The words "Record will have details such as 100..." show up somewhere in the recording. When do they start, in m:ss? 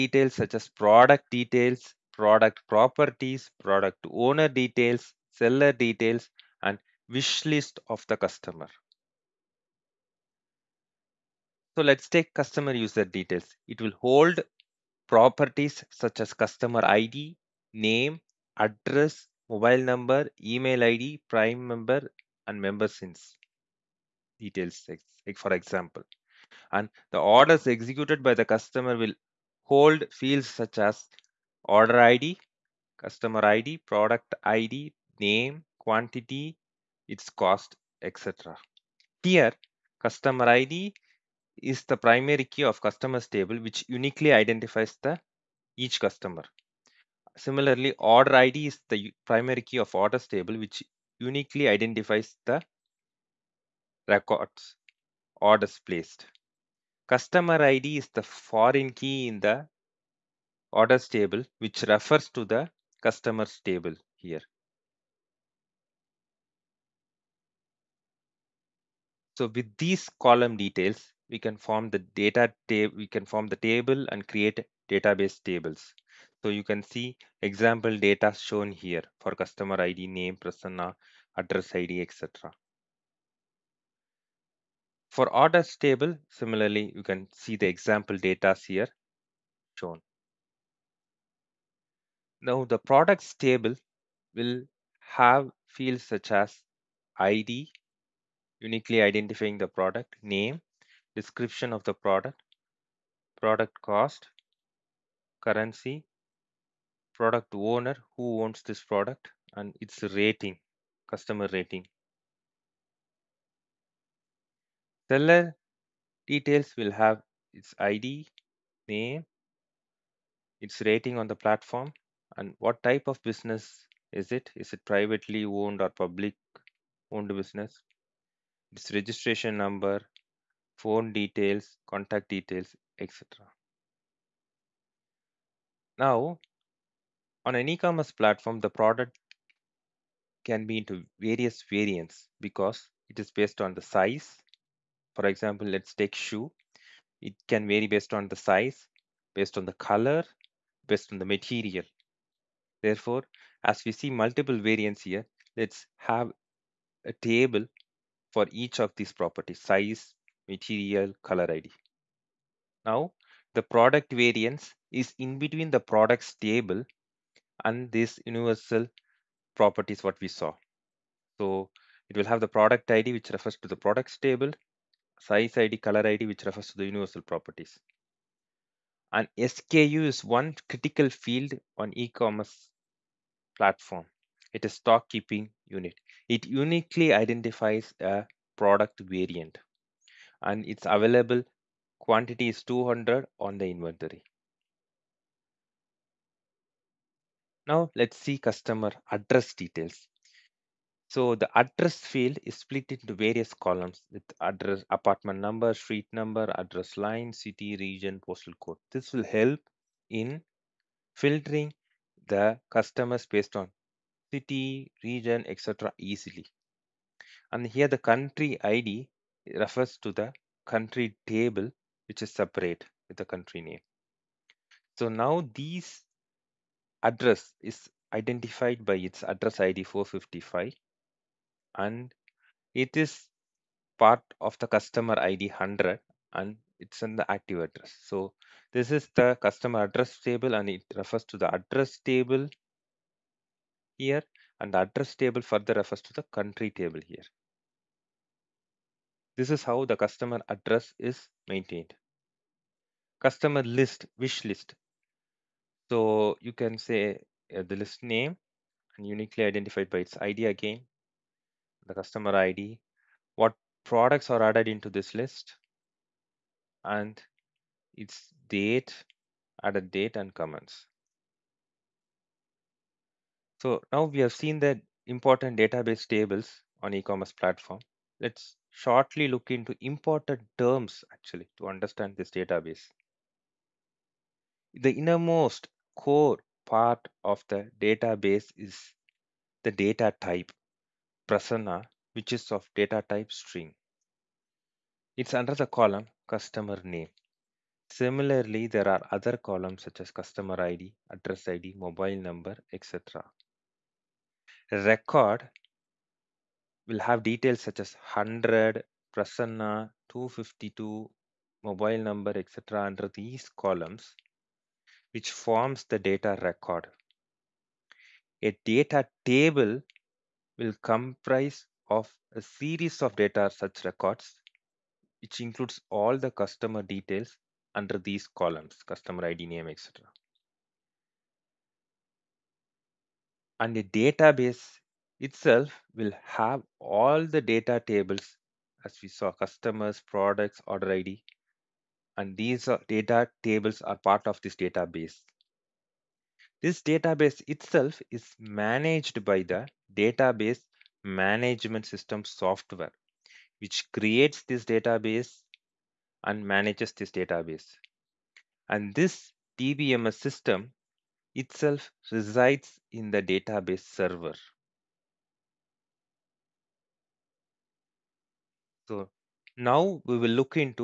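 5:04.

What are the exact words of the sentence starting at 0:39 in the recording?
Here, customer ID is the primary key of customers table which uniquely identifies the each customer.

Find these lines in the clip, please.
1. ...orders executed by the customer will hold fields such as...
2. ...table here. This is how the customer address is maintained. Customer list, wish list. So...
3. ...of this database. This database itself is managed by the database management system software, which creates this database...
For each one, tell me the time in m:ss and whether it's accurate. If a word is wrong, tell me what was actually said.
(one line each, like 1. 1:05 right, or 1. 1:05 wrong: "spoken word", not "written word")
1. 0:27 right
2. 4:06 right
3. 5:44 right.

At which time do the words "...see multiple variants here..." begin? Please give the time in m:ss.
2:33.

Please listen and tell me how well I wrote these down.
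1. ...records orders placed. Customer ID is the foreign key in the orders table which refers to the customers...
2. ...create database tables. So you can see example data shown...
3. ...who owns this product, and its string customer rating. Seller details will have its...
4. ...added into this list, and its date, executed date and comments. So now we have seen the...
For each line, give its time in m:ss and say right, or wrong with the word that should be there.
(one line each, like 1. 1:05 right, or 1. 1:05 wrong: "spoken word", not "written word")
1. 0:54 right
2. 1:14 right
3. 1:48 wrong: "rating", not "string"
4. 4:24 wrong: "added", not "executed".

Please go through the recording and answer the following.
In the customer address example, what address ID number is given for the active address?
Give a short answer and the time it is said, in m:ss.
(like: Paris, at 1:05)
455, at 3:49.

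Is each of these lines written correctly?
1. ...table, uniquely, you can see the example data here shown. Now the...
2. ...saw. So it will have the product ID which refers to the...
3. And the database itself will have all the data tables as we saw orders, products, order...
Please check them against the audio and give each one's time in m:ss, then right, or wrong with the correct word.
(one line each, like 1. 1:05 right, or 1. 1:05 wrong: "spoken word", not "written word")
1. 1:25 wrong: "similarly", not "uniquely"
2. 2:50 right
3. 5:33 wrong: "customers", not "orders".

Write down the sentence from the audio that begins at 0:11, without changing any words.
So let's take customer user details.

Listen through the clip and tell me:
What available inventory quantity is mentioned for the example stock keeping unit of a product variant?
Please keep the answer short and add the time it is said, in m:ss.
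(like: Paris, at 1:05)
200, at 3:12.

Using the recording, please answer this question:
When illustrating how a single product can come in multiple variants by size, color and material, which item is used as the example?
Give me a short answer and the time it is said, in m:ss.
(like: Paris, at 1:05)
shoe, at 2:26.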